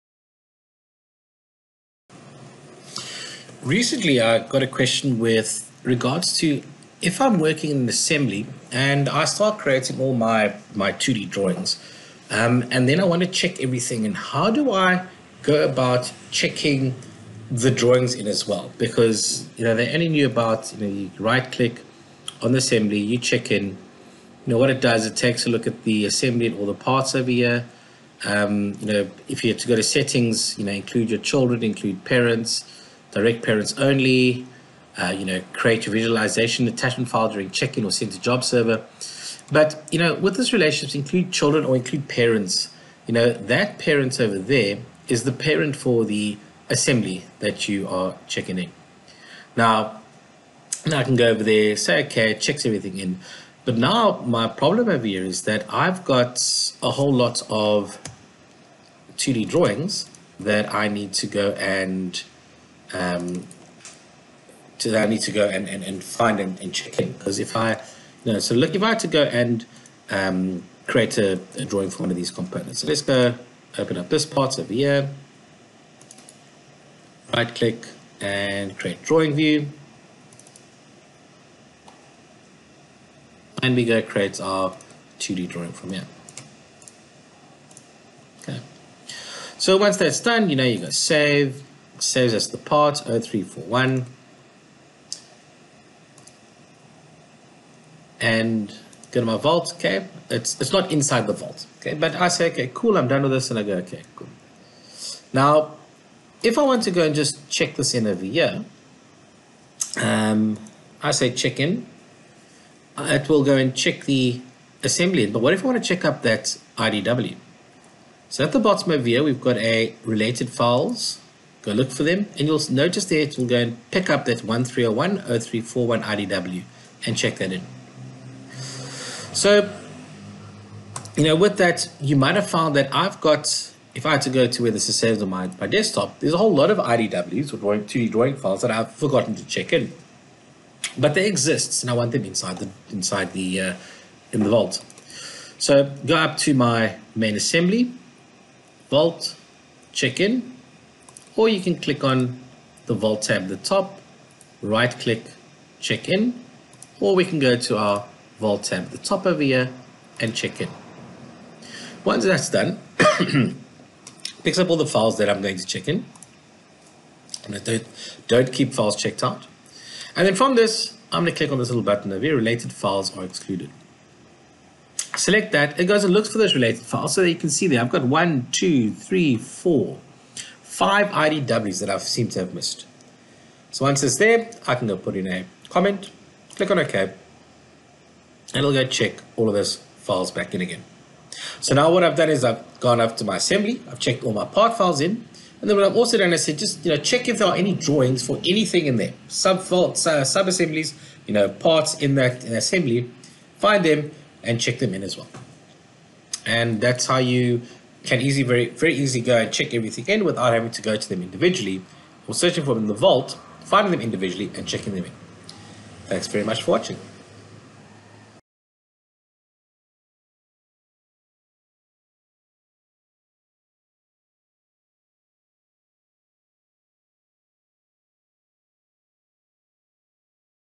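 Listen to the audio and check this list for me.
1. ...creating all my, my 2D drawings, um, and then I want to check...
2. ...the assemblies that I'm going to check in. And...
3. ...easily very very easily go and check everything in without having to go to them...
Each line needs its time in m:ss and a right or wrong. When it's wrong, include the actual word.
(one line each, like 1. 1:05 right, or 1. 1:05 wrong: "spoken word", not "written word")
1. 0:09 right
2. 2:44 wrong: "files", not "assemblies"
3. 3:28 right.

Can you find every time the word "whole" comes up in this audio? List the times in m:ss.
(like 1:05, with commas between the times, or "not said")
0:56, 2:16.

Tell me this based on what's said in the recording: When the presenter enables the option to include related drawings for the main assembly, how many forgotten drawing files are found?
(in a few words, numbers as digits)
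5.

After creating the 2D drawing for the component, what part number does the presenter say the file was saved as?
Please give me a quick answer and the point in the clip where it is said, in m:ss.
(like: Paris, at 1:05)
0341, at 1:32.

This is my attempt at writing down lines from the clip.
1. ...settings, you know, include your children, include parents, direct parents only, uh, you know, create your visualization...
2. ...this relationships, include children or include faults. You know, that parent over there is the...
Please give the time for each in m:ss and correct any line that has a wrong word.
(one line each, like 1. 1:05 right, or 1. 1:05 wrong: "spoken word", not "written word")
1. 0:29 right
2. 0:40 wrong: "parents", not "faults".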